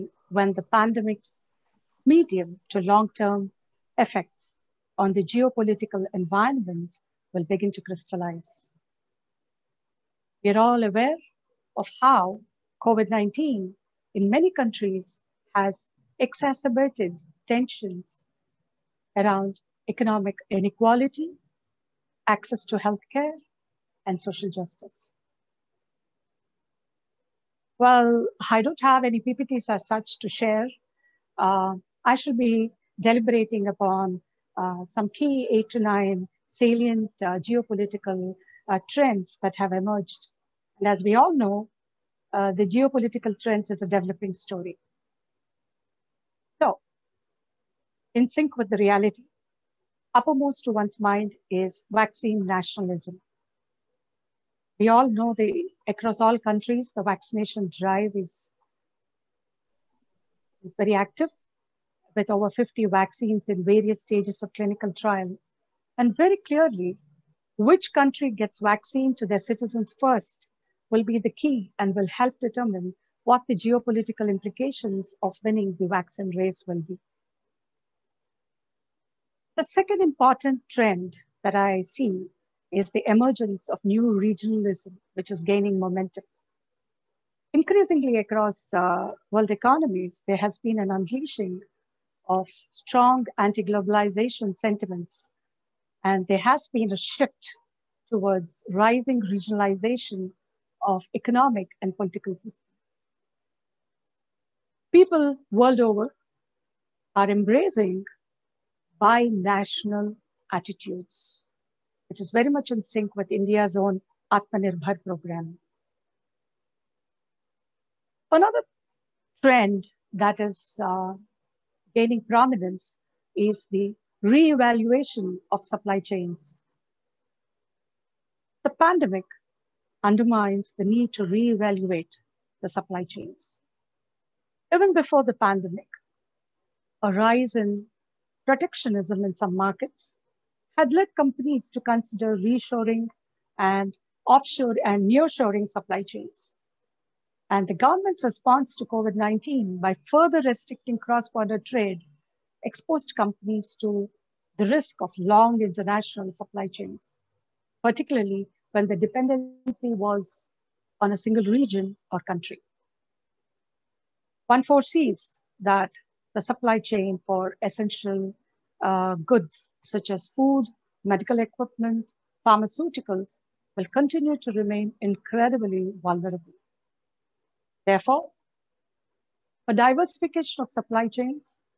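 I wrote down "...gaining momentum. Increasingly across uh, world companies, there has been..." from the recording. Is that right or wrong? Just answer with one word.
wrong.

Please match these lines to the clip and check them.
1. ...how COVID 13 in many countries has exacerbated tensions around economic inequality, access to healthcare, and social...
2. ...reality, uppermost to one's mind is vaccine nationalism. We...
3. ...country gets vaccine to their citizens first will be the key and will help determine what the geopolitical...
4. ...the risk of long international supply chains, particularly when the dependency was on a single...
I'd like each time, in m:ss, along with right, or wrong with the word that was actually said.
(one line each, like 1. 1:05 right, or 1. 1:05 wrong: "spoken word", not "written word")
1. 0:12 wrong: "19", not "13"
2. 0:48 right
3. 1:07 right
4. 2:34 right.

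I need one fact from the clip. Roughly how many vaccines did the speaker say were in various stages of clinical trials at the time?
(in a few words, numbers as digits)
over 50.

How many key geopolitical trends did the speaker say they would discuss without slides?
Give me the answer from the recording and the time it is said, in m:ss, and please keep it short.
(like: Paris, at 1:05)
8 to 9, at 0:35.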